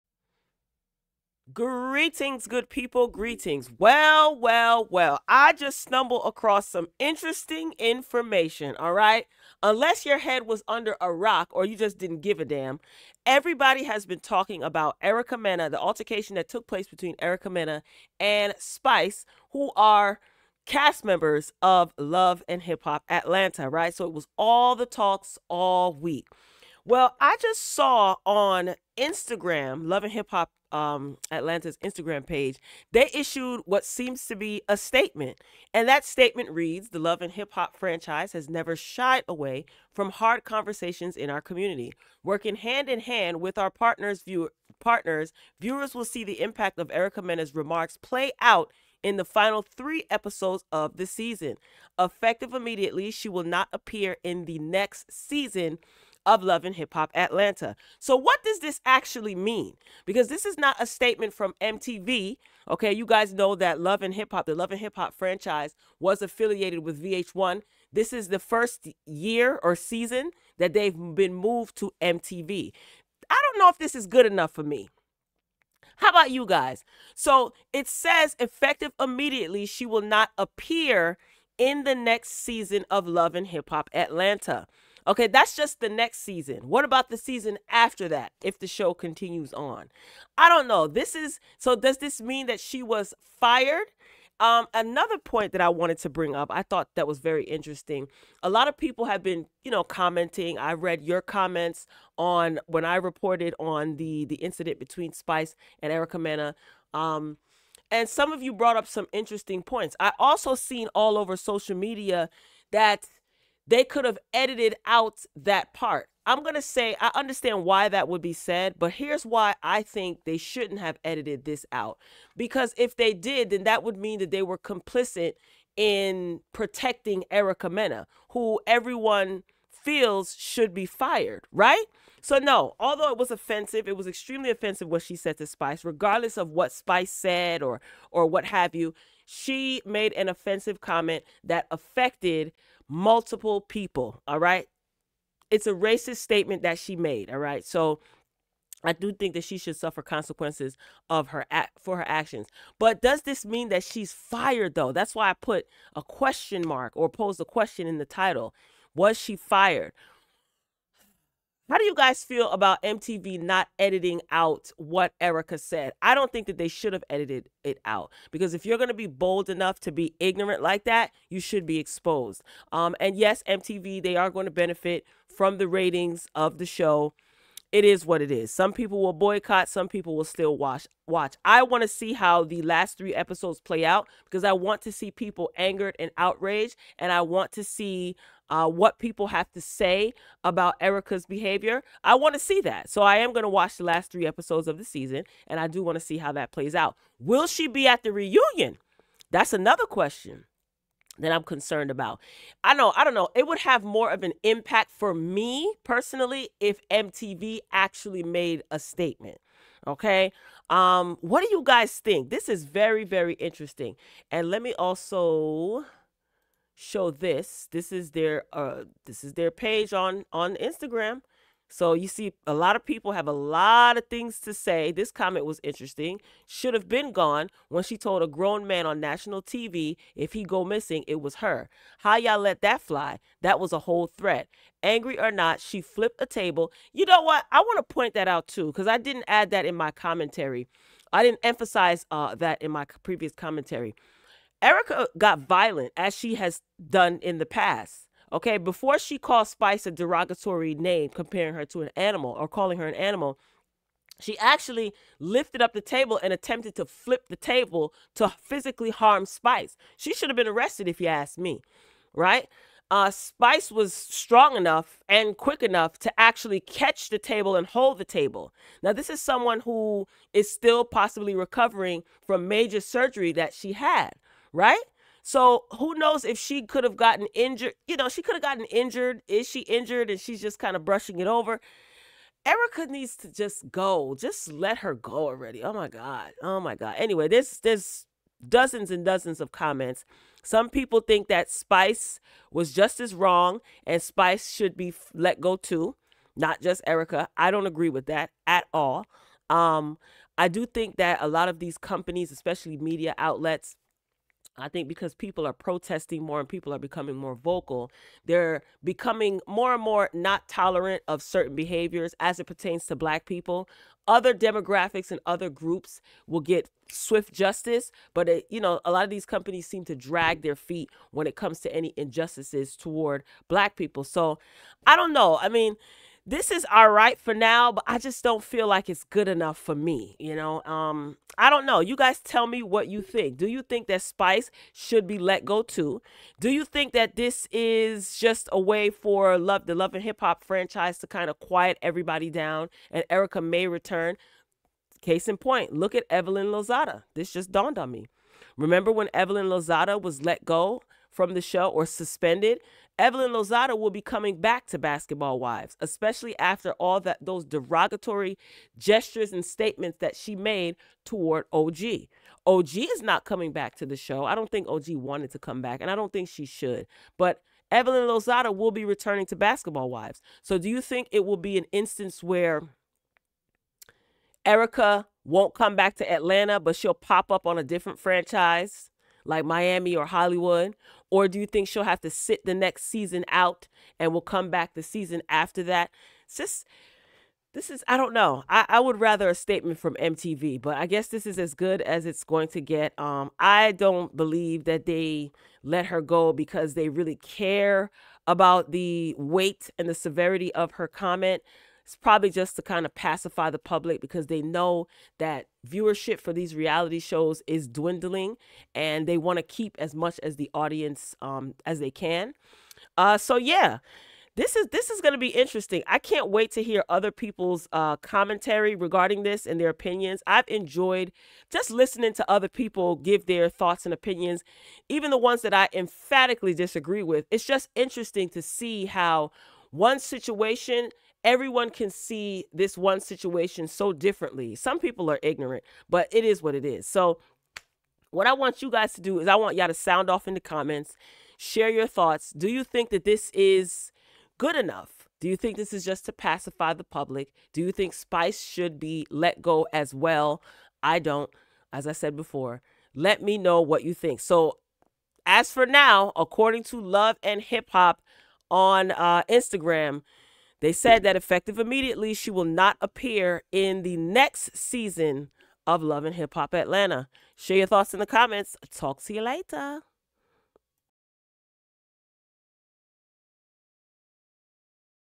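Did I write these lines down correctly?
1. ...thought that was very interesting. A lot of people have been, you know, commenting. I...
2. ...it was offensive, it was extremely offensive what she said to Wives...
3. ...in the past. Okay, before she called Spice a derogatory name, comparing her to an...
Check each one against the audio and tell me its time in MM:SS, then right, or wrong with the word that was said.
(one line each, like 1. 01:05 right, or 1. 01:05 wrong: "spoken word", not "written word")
1. 01:36 right
2. 02:13 wrong: "Spice", not "Wives"
3. 04:07 right.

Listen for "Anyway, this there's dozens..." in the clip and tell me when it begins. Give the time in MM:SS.
04:46.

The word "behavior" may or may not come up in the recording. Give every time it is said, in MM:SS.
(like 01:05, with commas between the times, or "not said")
03:11, 05:11.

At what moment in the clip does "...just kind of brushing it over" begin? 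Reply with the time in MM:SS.
04:40.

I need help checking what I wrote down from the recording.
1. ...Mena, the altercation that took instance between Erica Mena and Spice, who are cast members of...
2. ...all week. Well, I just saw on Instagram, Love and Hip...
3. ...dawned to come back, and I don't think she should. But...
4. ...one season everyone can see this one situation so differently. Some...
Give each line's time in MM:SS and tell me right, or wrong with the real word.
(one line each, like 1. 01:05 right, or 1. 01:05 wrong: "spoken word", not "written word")
1. 00:15 wrong: "place", not "instance"
2. 00:25 right
3. 06:04 wrong: "wanted", not "dawned"
4. 07:09 wrong: "situation", not "season".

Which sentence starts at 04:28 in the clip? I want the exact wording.
Now, this is someone who is still possibly recovering from major surgery that she had, right?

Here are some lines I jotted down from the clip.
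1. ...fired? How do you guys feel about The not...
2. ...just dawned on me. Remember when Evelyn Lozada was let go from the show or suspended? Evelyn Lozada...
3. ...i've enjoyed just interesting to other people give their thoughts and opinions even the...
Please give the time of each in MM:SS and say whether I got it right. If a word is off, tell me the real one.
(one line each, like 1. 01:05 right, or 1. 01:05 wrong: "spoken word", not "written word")
1. 02:39 wrong: "MTV", not "The"
2. 05:47 right
3. 07:00 wrong: "listening", not "interesting".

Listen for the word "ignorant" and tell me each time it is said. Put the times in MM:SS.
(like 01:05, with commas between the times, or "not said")
02:50, 07:15.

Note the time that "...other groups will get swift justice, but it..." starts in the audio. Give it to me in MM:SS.
05:15.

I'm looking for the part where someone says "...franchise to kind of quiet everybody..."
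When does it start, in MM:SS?
05:40.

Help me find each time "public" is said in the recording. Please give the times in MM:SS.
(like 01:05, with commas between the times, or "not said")
06:43, 07:26.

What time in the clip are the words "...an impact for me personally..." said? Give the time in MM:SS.
03:24.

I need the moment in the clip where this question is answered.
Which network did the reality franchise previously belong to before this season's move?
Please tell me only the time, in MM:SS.
01:07.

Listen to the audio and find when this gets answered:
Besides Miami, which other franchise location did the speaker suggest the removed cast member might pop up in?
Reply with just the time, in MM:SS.
06:20.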